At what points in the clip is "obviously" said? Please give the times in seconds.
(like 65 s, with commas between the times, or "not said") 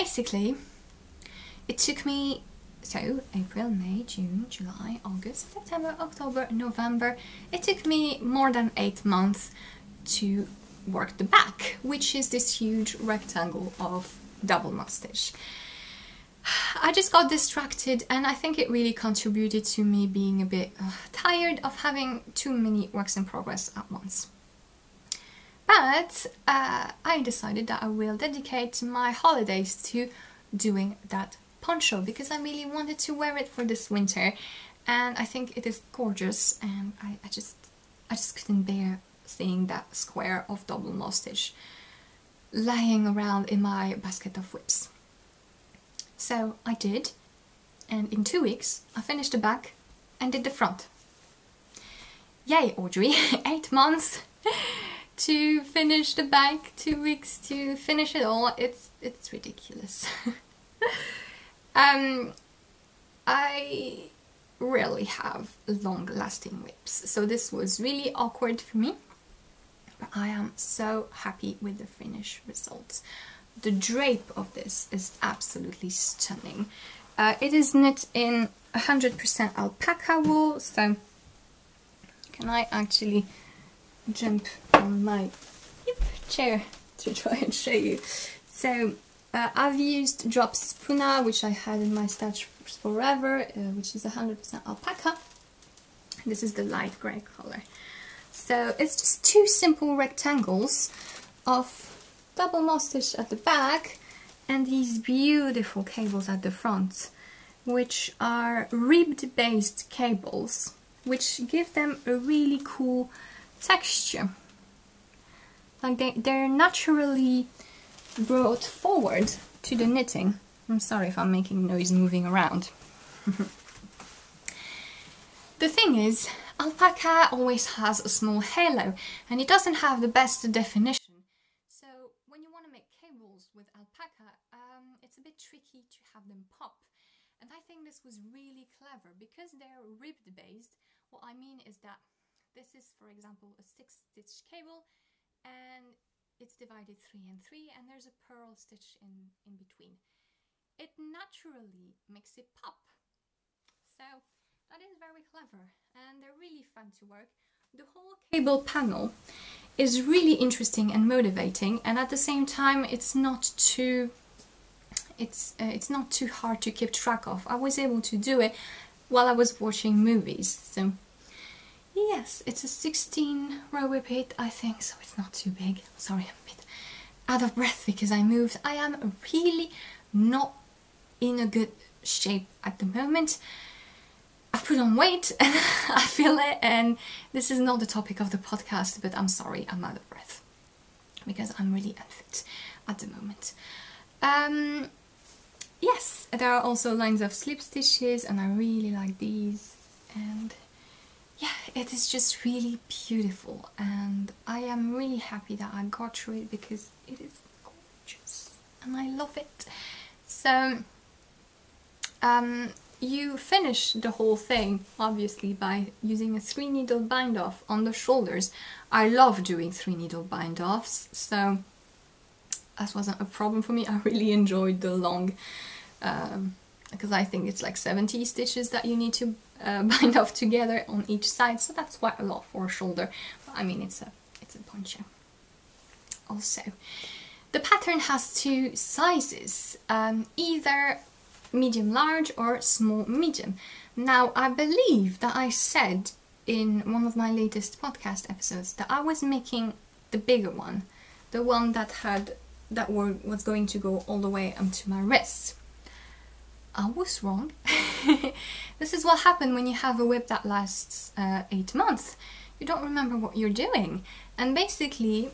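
214 s.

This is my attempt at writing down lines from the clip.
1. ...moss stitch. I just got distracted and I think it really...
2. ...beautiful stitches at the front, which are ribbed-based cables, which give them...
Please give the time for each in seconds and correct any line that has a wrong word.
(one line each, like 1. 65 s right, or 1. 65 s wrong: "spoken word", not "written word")
1. 14 s right
2. 104 s wrong: "cables", not "stitches".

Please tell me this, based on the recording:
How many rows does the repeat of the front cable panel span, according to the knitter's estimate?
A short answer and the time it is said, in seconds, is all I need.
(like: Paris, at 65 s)
16, at 172 s.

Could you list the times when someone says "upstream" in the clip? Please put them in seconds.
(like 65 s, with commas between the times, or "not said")
not said.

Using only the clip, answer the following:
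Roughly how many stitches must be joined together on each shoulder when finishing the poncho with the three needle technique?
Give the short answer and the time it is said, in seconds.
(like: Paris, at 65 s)
70, at 227 s.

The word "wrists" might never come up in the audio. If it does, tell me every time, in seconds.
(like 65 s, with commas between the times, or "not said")
254 s.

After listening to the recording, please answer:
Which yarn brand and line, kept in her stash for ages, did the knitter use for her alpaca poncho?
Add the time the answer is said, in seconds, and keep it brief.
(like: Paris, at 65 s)
Drops Puna, at 90 s.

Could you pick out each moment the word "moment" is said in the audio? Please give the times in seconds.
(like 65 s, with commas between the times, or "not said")
182 s, 193 s.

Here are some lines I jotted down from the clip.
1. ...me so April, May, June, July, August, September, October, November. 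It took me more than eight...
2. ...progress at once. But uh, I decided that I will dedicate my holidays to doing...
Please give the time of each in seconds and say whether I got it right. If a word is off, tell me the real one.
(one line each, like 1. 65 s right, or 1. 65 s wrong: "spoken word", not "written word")
1. 2 s right
2. 23 s right.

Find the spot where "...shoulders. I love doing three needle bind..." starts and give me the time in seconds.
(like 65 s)
217 s.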